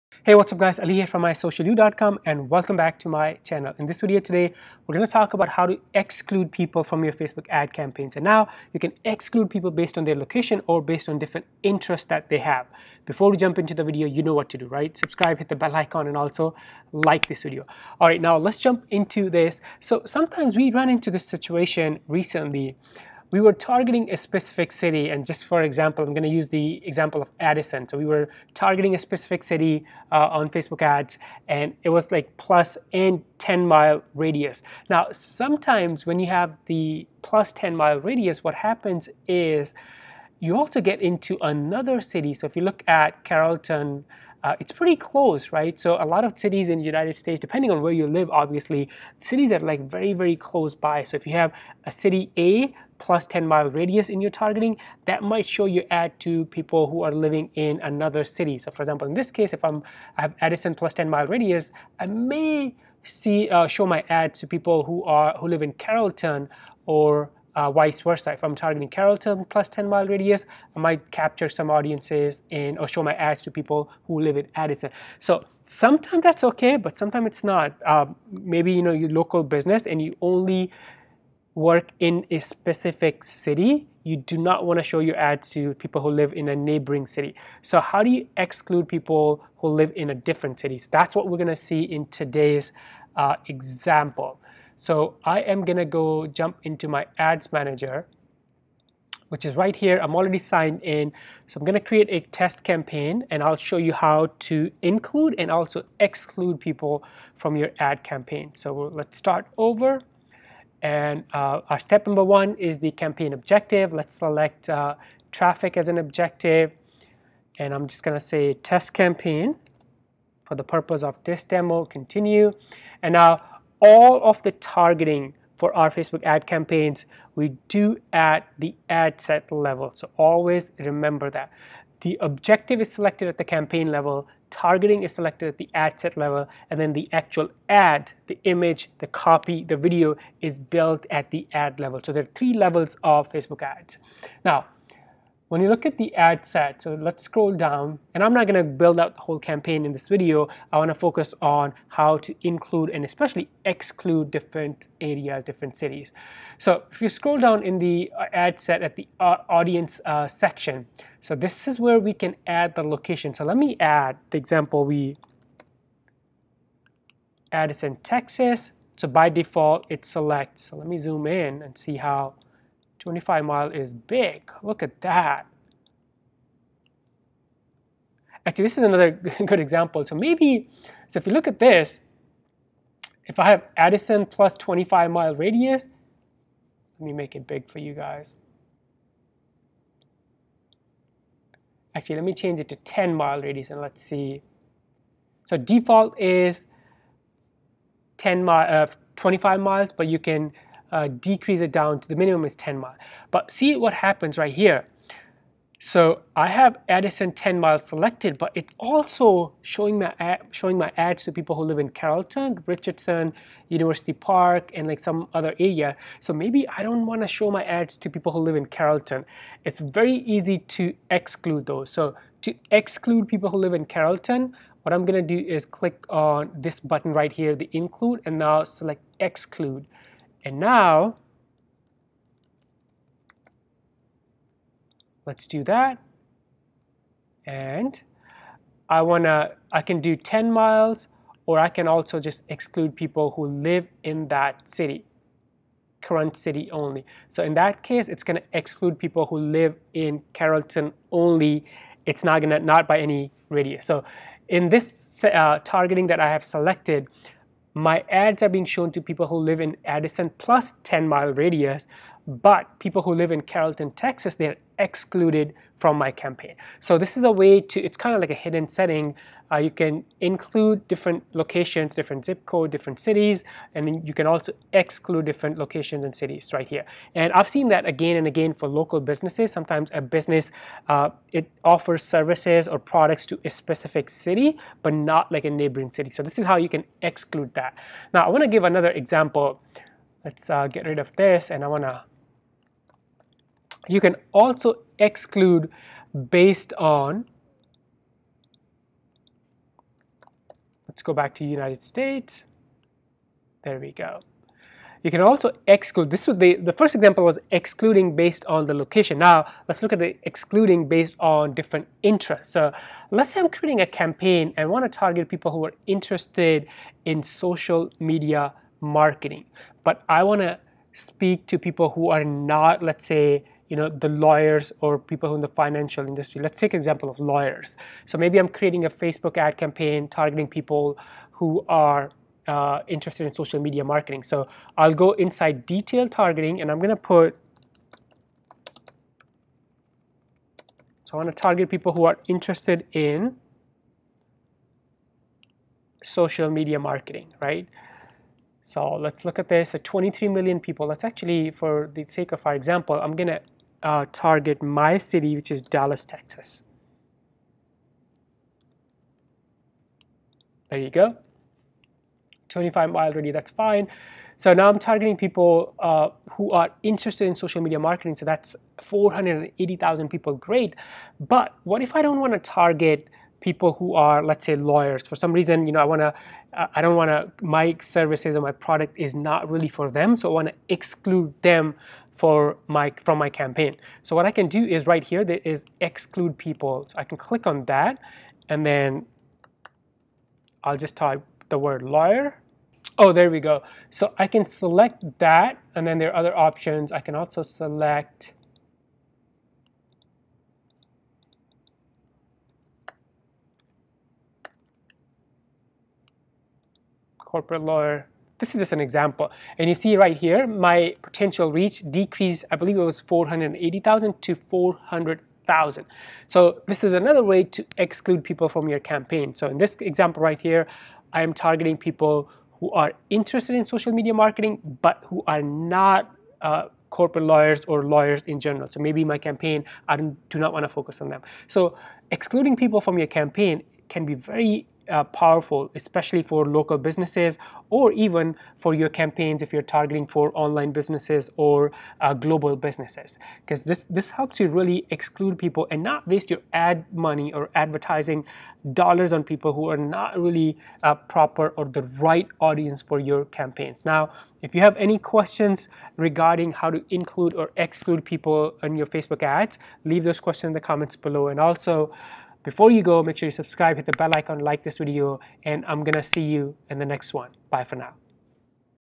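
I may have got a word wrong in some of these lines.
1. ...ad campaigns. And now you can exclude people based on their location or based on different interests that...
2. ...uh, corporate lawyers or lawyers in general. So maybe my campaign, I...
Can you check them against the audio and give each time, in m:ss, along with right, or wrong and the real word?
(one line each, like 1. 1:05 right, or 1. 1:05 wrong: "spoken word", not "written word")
1. 0:07 right
2. 7:06 right.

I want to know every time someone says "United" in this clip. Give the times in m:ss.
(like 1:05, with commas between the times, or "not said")
0:46, 5:01.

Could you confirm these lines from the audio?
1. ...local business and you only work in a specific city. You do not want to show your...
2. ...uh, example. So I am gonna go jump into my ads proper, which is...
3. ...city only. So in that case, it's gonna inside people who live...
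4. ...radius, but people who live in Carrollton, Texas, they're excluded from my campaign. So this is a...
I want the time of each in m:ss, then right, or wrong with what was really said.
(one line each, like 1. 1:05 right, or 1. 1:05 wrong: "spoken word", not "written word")
1. 1:19 right
2. 1:33 wrong: "manager", not "proper"
3. 4:06 wrong: "exclude", not "inside"
4. 4:21 right.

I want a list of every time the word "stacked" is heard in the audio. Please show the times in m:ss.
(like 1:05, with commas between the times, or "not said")
not said.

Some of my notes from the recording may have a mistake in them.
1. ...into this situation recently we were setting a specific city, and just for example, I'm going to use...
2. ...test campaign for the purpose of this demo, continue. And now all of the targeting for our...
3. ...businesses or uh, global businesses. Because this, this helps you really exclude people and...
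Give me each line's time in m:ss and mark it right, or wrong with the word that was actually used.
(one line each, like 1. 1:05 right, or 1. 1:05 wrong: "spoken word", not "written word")
1. 0:20 wrong: "targeting", not "setting"
2. 1:58 right
3. 7:20 right.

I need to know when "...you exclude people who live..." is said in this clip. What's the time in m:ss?
1:28.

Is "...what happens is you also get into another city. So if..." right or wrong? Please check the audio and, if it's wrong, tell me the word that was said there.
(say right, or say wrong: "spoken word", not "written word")
right.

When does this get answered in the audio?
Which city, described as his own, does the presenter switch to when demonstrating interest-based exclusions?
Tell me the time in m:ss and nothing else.
5:55.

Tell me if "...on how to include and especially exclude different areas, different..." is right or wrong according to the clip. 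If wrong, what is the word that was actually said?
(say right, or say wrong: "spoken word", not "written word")
right.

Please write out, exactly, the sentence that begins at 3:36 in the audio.
So maybe I don't want to show my ads to people who live in Carrollton.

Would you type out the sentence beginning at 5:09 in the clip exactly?
Now, let's look at the excluding based on different interests.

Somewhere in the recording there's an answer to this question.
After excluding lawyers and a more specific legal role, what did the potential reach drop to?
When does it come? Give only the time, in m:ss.
6:54.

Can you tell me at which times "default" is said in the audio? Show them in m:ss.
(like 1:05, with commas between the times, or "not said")
2:49, 3:15.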